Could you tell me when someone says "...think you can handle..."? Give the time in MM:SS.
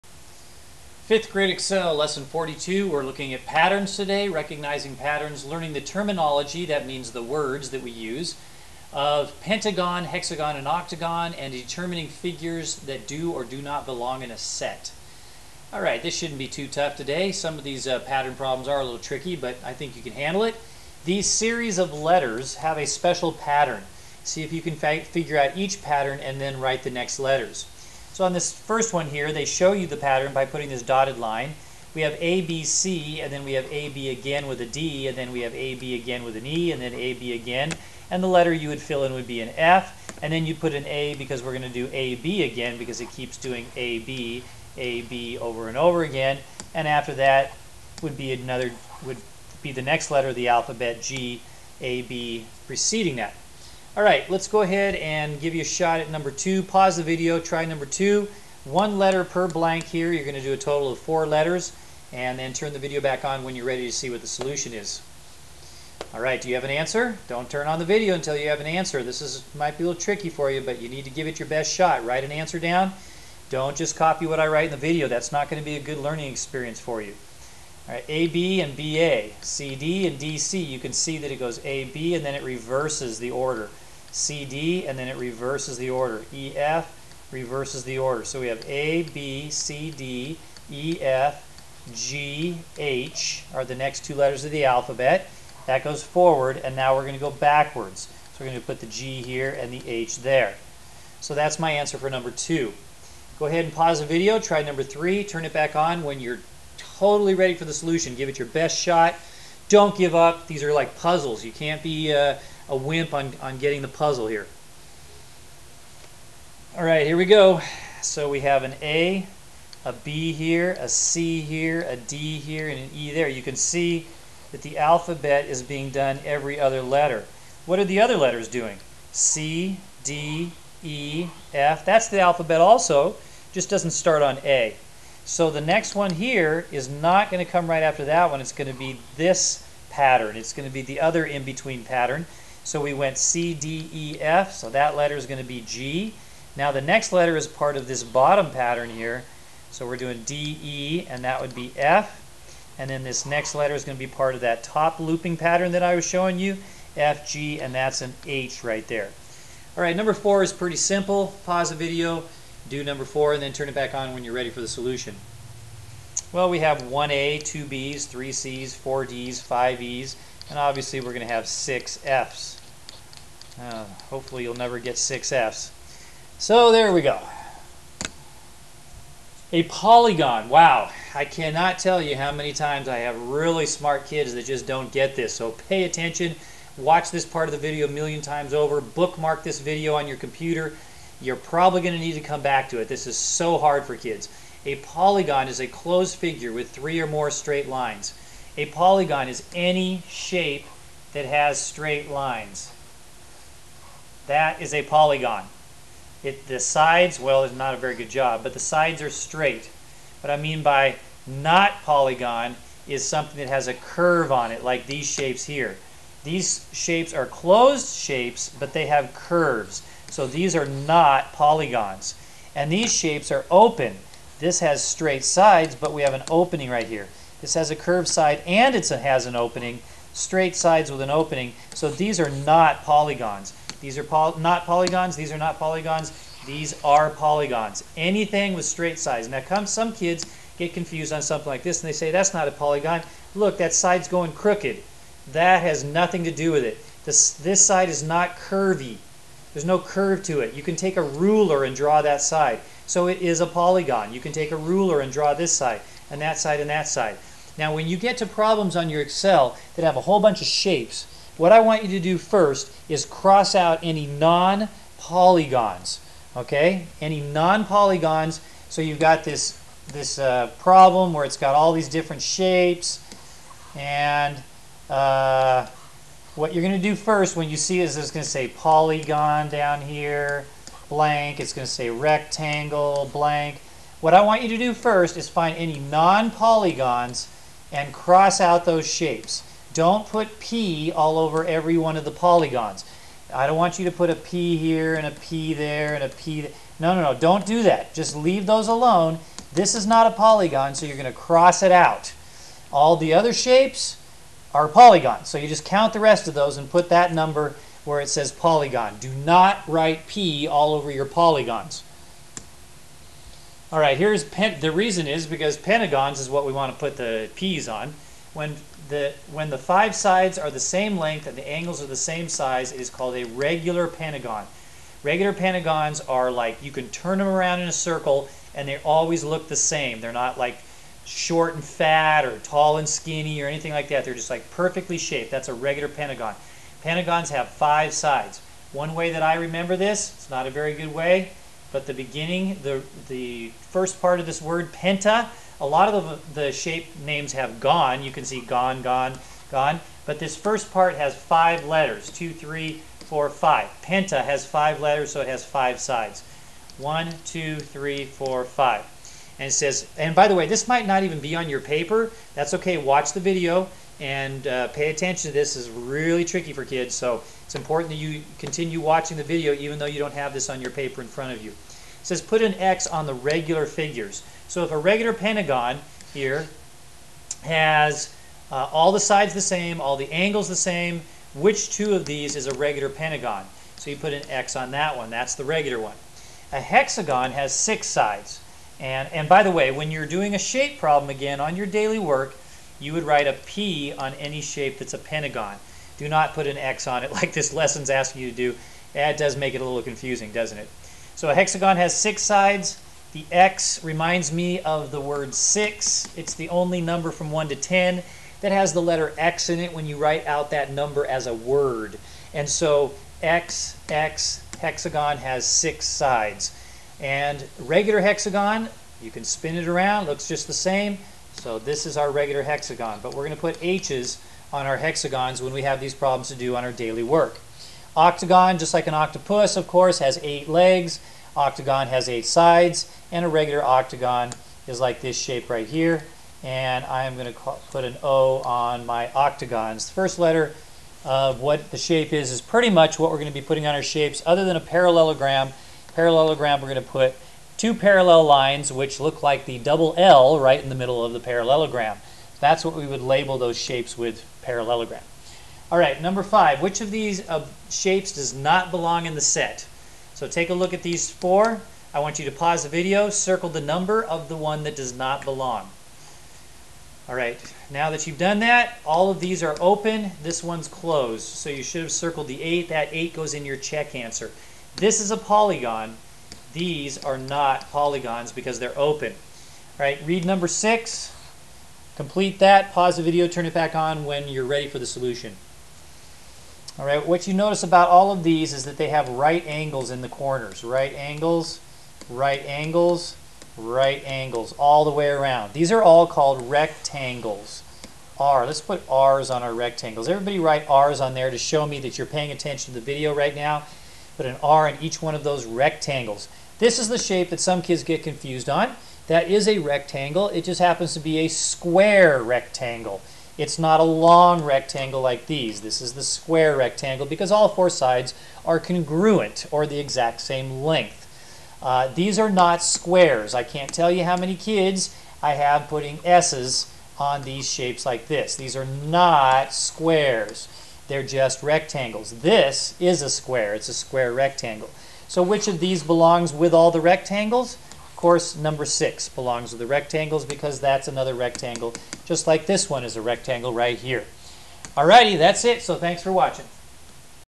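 00:19.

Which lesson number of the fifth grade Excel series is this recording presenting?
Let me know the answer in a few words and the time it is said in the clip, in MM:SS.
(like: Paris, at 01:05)
42, at 00:01.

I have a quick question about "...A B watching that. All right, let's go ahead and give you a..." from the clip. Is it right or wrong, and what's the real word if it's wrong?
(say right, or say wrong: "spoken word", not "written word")
wrong: "preceding", not "watching".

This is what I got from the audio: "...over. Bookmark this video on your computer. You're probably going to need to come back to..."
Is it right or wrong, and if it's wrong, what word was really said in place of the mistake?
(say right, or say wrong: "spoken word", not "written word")
right.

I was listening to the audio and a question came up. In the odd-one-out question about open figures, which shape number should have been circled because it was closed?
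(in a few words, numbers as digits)
8.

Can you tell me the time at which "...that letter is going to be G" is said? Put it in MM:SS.
02:24.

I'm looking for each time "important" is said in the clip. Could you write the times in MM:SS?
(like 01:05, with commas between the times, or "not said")
06:07.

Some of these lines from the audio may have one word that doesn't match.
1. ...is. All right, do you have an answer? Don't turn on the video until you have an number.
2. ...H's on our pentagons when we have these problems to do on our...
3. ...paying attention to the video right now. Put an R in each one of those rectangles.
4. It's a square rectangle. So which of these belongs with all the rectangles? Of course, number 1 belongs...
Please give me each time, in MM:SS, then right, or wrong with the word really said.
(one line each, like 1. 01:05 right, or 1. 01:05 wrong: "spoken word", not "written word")
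1. 01:04 wrong: "answer", not "number"
2. 07:03 wrong: "hexagons", not "pentagons"
3. 08:22 right
4. 08:53 wrong: "6", not "1".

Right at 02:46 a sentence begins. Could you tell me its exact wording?
Well, we have 1A, 2Bs, 3Cs, 4Ds, 5Es, and obviously we're going to have six Fs.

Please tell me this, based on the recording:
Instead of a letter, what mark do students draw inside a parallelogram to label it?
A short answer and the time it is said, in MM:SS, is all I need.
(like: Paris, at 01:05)
Two parallel lines, at 07:27.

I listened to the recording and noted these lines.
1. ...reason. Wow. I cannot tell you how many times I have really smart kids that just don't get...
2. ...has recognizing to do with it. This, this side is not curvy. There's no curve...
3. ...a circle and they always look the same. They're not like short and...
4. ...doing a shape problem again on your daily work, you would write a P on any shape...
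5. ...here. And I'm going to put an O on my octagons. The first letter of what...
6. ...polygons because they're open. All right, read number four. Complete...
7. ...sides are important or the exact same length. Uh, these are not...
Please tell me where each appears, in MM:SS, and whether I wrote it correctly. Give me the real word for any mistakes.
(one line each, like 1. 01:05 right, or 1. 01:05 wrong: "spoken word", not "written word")
1. 02:59 wrong: "polygon", not "reason"
2. 04:05 wrong: "nothing", not "recognizing"
3. 05:27 right
4. 06:30 right
5. 07:15 right
6. 07:57 wrong: "six", not "four"
7. 08:37 wrong: "congruent", not "important".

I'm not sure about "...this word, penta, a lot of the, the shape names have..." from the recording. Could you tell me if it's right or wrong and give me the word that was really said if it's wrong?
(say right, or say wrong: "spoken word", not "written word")
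right.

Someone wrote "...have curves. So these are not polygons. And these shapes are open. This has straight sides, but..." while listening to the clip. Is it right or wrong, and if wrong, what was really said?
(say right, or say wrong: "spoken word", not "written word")
right.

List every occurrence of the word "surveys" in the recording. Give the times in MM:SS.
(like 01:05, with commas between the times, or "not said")
not said.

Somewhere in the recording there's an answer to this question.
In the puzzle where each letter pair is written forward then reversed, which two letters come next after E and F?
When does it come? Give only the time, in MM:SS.
01:31.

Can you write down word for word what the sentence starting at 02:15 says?
So the next one here is not going to come right after that one.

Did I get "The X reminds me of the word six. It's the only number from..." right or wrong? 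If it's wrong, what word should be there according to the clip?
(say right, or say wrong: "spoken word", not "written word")
right.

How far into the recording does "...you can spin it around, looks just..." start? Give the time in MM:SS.
06:59.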